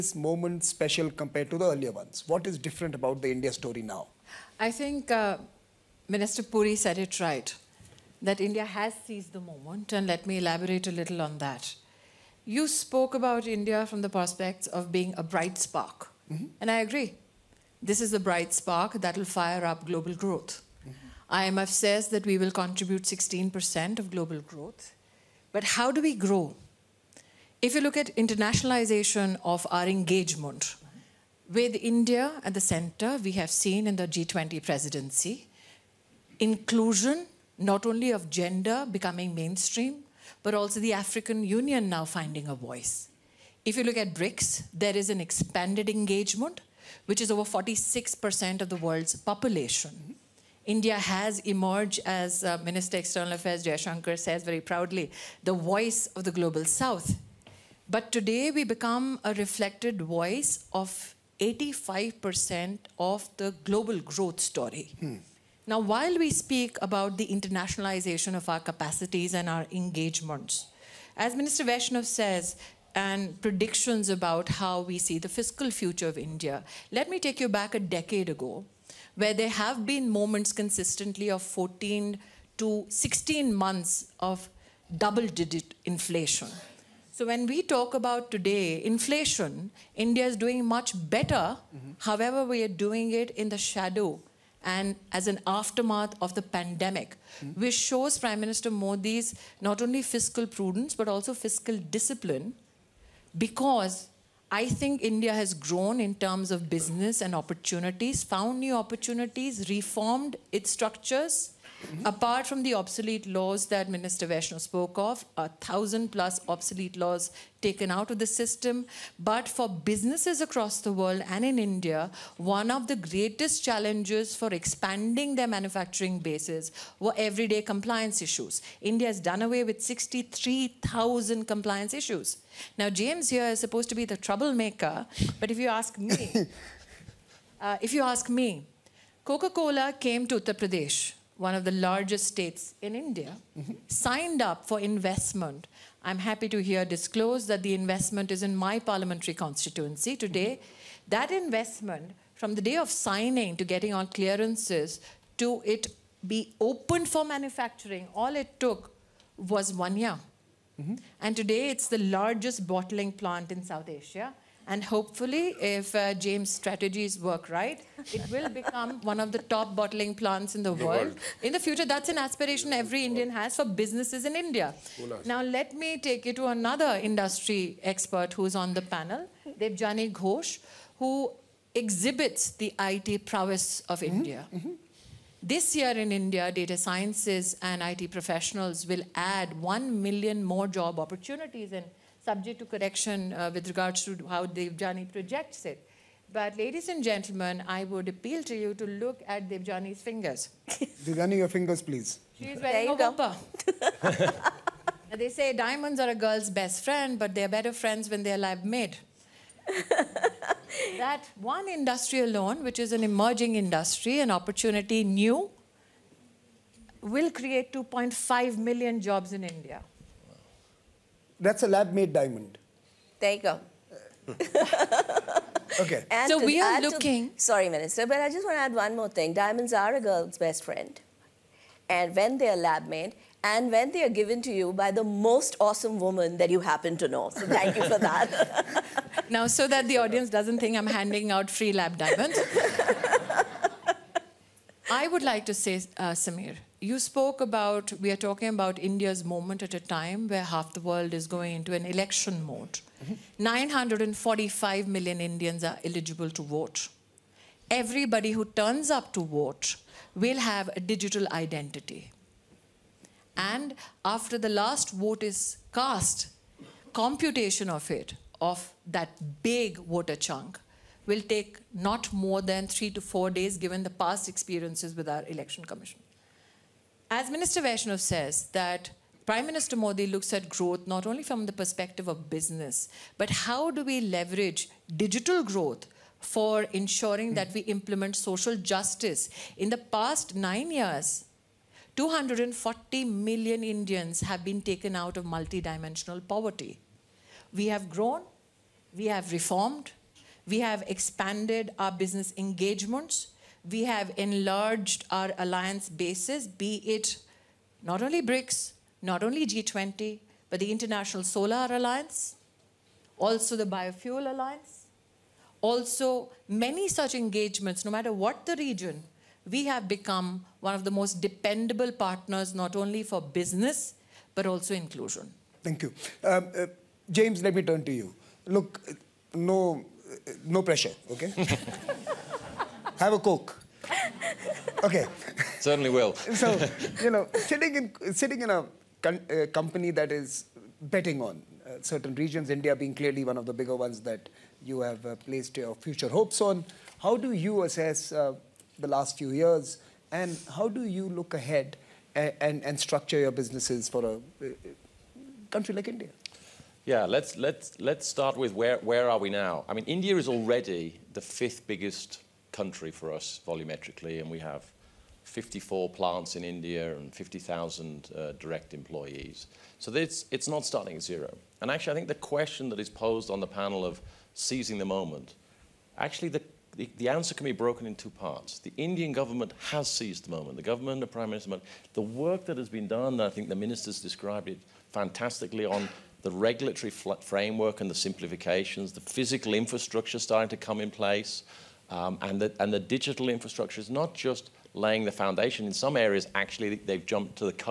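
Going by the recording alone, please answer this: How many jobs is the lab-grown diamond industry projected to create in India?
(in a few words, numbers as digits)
2.5 million.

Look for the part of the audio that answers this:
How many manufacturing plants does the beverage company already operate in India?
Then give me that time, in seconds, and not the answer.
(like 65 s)
365 s.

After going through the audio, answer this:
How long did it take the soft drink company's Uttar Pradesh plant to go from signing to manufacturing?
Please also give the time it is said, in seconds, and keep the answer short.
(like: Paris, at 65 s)
one year, at 159 s.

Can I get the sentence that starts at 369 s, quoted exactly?
So it's, it's not starting at zero.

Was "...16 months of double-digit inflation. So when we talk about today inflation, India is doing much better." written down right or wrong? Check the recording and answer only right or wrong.
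right.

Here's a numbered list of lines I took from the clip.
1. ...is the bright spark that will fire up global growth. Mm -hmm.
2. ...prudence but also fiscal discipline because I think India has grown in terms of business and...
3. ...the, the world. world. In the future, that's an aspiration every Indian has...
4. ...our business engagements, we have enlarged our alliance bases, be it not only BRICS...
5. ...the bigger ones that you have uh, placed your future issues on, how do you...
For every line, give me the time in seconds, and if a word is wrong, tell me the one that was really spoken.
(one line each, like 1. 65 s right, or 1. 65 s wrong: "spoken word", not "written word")
1. 17 s right
2. 100 s right
3. 170 s right
4. 301 s right
5. 343 s wrong: "hopes", not "issues".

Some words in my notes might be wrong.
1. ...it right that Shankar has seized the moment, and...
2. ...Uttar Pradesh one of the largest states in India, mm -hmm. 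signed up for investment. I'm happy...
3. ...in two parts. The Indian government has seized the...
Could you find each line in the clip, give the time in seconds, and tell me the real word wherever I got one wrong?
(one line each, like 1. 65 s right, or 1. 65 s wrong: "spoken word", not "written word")
1. 6 s wrong: "India", not "Shankar"
2. 140 s right
3. 377 s right.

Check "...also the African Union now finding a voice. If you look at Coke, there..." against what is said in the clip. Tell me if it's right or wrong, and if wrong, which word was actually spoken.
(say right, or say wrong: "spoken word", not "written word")
wrong: "BRICS", not "Coke".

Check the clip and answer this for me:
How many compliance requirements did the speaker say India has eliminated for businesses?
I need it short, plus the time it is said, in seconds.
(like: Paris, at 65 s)
63,000, at 129 s.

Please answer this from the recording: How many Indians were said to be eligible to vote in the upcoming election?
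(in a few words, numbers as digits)
945 million.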